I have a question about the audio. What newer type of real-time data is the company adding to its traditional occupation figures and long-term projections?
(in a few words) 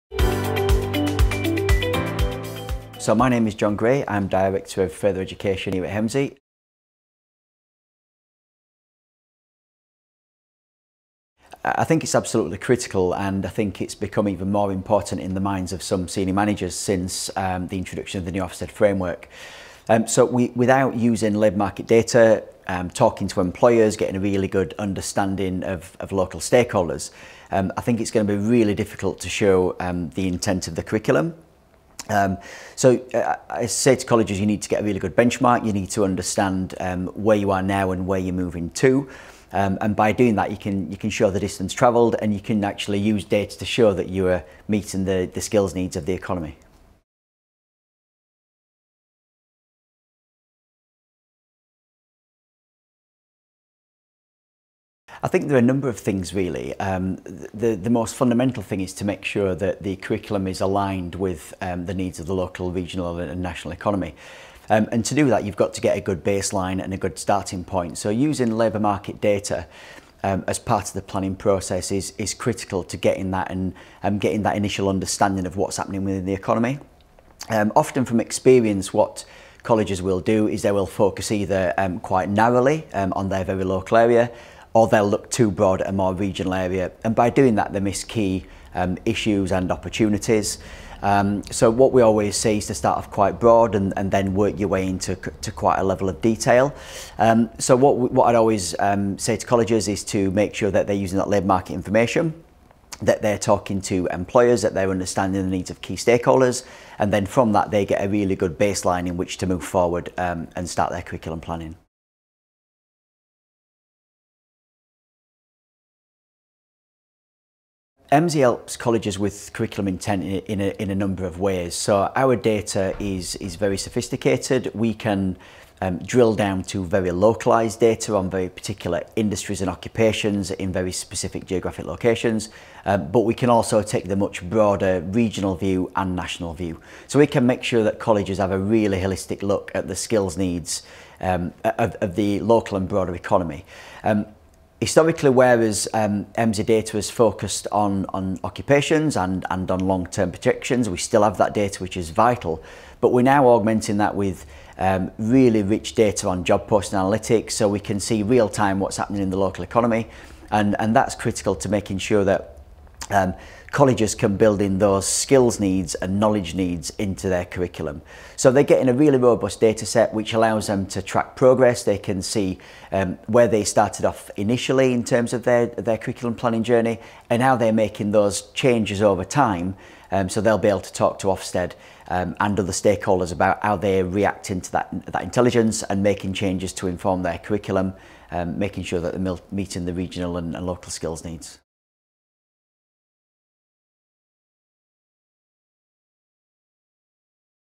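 Job post analytics.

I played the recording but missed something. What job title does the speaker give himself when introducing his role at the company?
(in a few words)
Director of Further Education.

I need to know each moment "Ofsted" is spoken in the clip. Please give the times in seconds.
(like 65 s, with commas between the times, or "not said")
18 s, 181 s.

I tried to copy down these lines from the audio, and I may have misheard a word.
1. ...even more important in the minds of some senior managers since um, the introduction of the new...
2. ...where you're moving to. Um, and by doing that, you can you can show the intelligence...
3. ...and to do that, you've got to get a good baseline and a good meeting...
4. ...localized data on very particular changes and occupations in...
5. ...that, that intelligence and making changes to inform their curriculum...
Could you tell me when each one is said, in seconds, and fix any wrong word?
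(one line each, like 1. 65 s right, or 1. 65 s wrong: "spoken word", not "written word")
1. 14 s right
2. 38 s wrong: "distance", not "intelligence"
3. 64 s wrong: "starting", not "meeting"
4. 127 s wrong: "industries", not "changes"
5. 184 s right.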